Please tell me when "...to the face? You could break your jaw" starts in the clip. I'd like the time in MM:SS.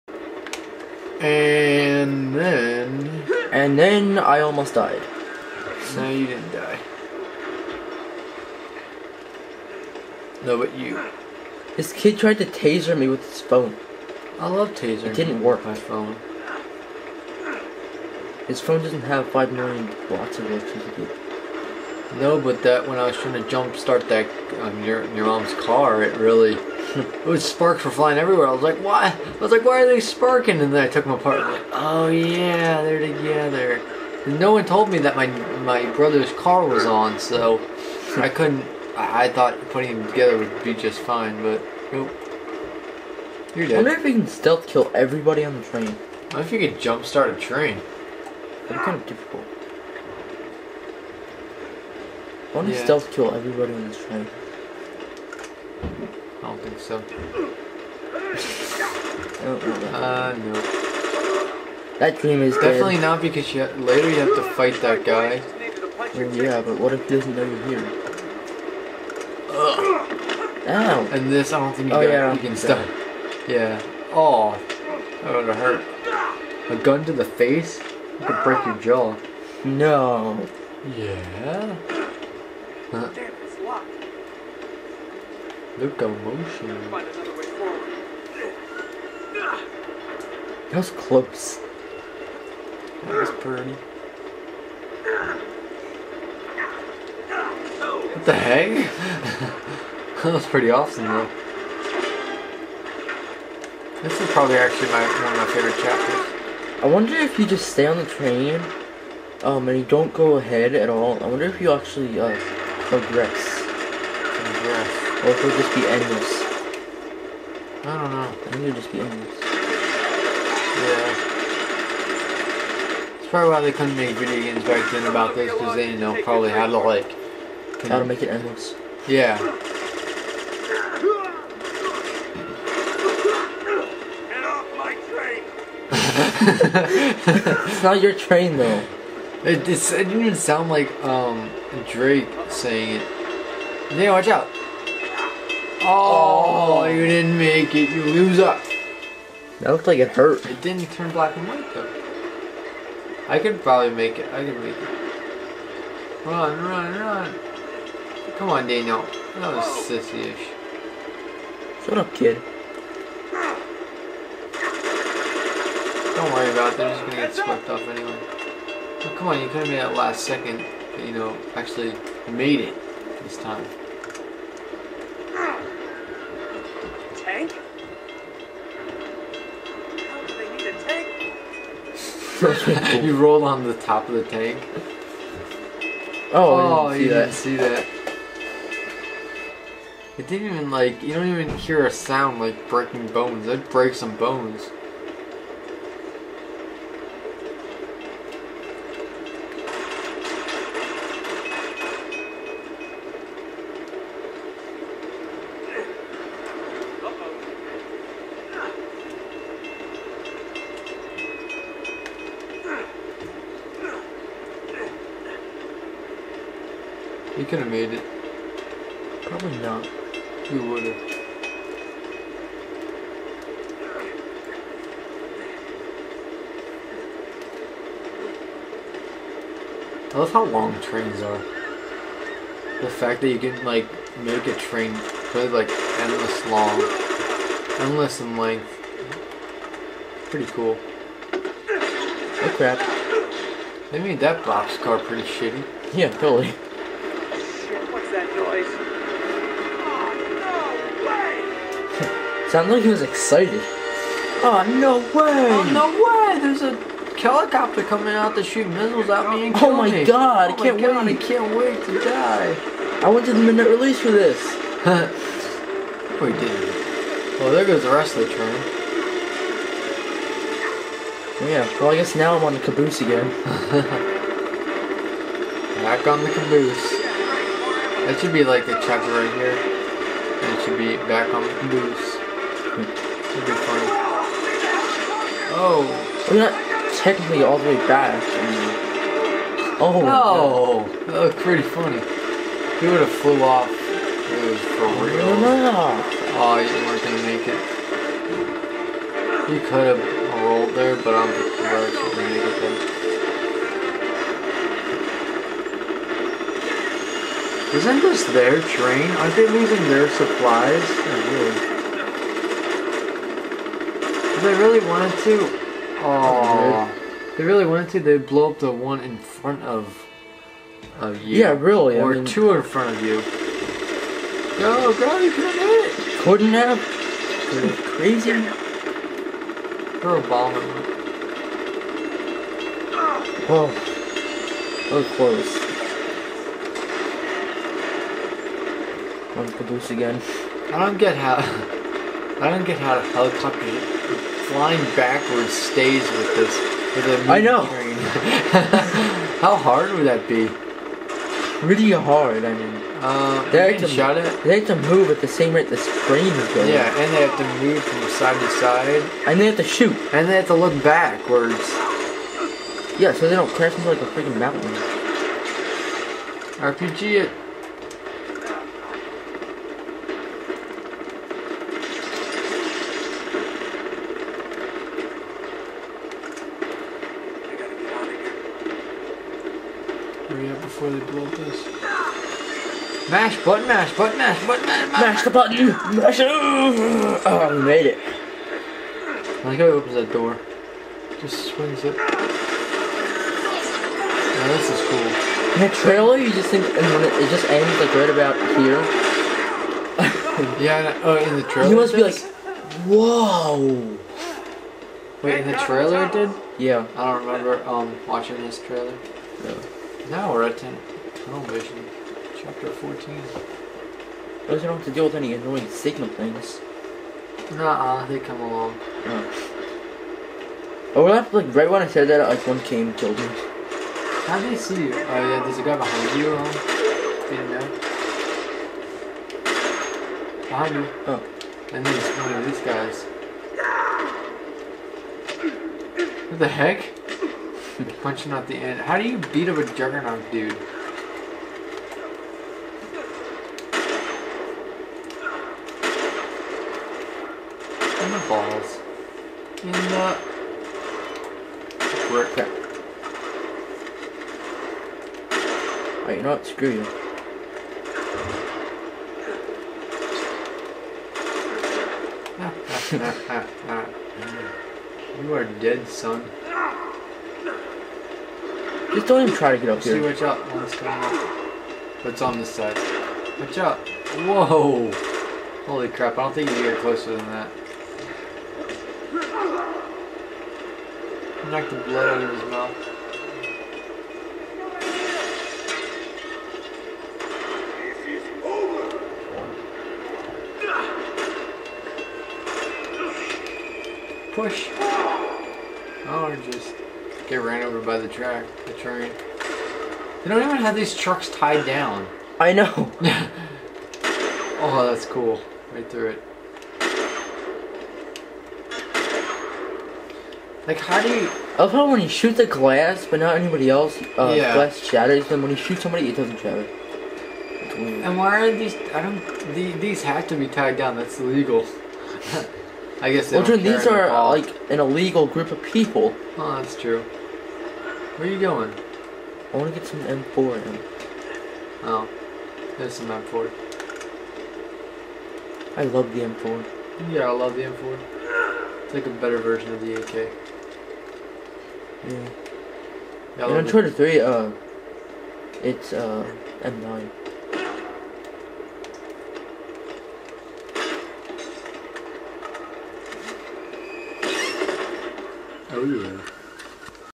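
01:17.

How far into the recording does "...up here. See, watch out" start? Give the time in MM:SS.
07:49.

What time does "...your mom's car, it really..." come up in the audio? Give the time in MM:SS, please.
00:25.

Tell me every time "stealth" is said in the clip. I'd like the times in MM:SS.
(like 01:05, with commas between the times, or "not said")
00:44, 00:52.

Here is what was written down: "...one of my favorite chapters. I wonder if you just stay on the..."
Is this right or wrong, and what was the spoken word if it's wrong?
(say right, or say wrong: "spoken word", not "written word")
right.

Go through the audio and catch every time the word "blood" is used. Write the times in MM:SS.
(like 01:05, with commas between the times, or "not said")
08:01.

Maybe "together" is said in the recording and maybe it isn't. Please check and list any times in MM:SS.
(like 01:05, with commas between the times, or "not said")
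00:32, 00:40.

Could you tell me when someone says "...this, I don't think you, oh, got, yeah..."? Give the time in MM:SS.
01:11.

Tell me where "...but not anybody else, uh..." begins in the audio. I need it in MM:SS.
08:33.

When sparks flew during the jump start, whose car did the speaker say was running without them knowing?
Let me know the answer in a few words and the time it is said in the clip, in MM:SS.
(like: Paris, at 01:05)
my brother's car, at 00:35.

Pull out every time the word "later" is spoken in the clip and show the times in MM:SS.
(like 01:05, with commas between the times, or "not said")
01:03.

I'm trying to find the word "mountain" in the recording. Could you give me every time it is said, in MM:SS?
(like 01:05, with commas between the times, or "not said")
06:04.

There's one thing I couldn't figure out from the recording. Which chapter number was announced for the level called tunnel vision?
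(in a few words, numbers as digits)
14.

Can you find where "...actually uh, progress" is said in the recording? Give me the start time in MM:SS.
01:51.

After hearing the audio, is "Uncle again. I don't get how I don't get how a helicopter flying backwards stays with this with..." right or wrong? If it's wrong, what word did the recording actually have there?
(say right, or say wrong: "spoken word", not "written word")
right.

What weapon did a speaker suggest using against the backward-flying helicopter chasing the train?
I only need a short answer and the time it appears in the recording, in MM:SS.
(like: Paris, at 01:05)
RPG, at 06:06.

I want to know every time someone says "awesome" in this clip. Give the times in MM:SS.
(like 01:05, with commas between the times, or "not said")
01:40.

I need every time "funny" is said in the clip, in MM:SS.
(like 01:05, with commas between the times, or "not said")
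04:43, 04:51.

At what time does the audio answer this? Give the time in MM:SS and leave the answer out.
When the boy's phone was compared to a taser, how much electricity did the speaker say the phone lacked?
00:19.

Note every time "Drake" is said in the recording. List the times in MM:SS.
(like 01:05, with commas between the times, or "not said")
02:21.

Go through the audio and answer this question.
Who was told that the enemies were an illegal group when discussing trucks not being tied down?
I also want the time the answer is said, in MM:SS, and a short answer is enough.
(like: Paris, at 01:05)
Jordan, at 08:43.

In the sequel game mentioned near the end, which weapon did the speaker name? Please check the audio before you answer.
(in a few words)
M9.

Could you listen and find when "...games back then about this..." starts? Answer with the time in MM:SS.
02:04.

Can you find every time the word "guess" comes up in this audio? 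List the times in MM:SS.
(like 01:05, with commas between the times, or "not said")
04:31, 08:43.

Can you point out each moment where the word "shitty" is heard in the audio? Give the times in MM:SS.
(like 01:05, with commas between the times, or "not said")
04:05.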